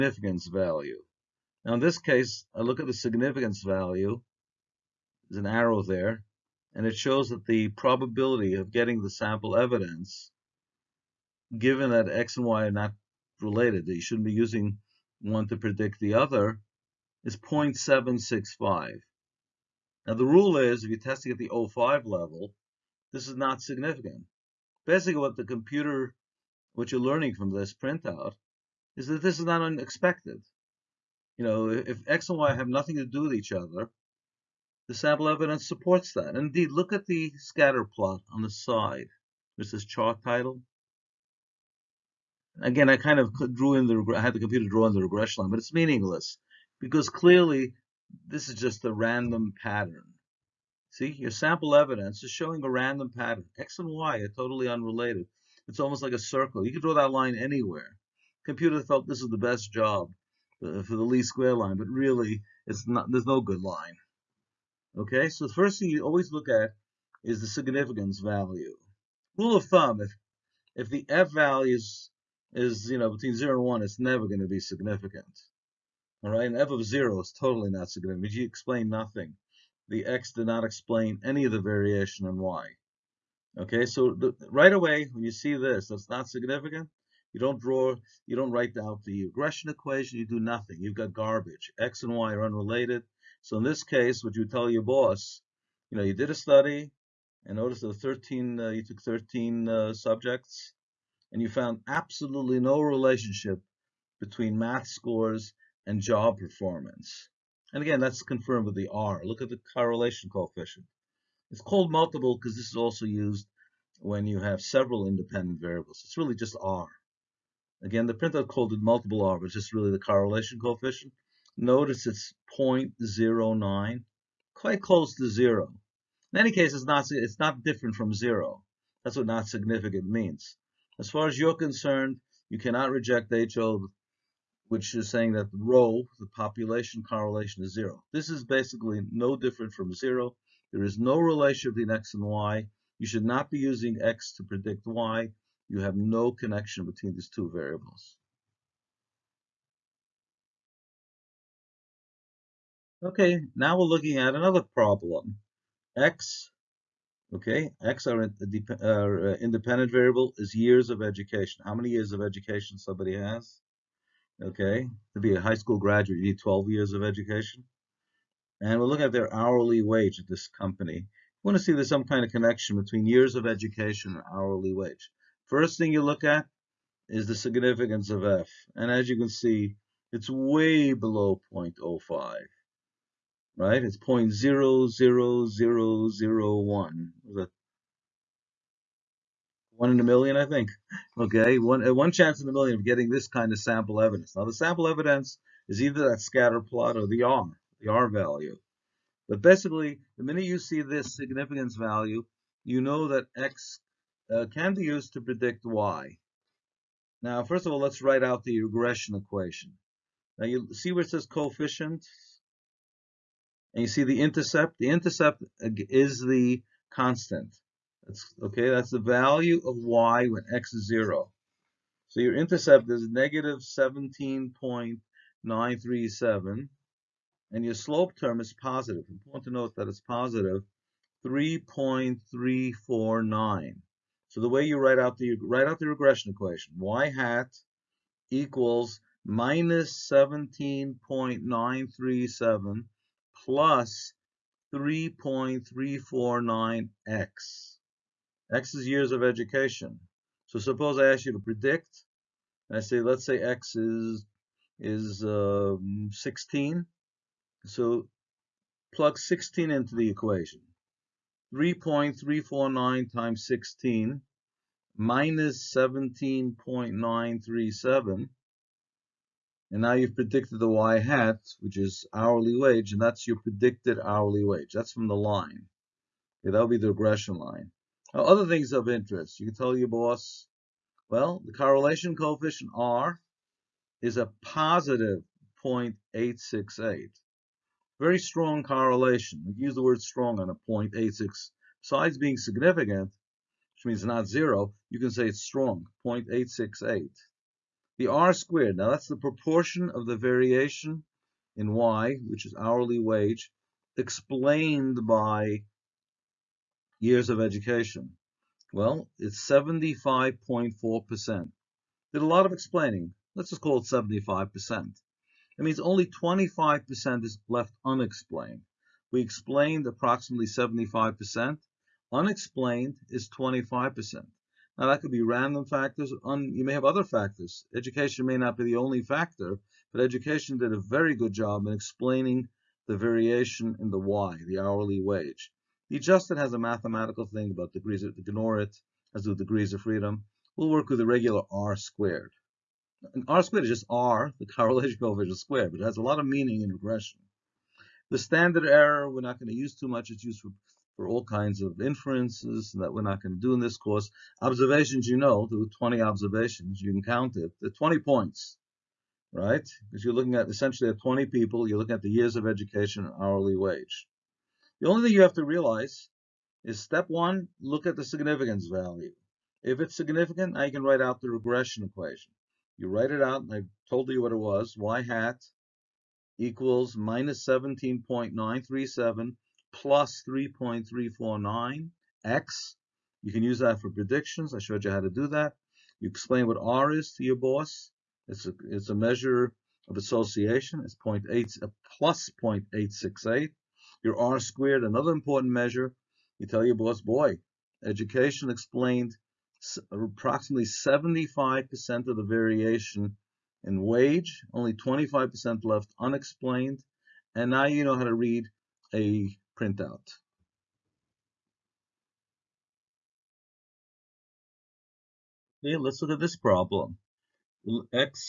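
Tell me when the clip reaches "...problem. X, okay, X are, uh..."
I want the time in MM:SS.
02:34.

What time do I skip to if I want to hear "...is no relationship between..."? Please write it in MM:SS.
02:20.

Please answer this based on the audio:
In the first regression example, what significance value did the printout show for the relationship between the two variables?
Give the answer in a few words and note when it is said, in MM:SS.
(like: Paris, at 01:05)
0.765, at 00:17.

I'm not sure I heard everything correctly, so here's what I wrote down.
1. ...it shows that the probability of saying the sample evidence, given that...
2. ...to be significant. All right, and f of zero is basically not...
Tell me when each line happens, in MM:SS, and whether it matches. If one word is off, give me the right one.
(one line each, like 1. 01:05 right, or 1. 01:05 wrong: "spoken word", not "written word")
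1. 00:06 wrong: "getting", not "saying"
2. 01:14 wrong: "totally", not "basically".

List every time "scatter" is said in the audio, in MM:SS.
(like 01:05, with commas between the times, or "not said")
00:37, 03:16.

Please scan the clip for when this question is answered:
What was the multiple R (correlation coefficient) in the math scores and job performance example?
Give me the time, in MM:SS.
02:02.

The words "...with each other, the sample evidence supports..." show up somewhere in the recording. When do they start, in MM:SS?
00:33.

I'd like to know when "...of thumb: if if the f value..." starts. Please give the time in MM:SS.
01:09.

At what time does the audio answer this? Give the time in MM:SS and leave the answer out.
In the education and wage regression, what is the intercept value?
03:43.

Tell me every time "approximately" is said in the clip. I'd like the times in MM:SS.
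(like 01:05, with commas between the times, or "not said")
05:19, 06:39.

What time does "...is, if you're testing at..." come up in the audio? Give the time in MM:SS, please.
00:20.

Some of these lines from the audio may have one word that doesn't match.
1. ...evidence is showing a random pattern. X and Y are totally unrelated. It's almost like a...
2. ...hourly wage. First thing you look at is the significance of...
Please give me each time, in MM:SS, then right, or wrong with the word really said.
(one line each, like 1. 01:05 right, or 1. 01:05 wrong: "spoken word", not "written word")
1. 00:51 right
2. 02:54 right.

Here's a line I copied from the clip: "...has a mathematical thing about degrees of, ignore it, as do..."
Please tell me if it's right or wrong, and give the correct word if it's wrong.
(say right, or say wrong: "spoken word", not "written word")
right.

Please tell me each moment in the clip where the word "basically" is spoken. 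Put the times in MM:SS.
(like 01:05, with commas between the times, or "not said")
00:24, 02:18, 03:19.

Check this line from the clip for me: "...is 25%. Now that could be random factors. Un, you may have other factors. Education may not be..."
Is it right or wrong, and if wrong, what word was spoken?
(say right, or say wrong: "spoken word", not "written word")
right.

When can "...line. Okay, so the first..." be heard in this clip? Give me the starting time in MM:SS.
01:03.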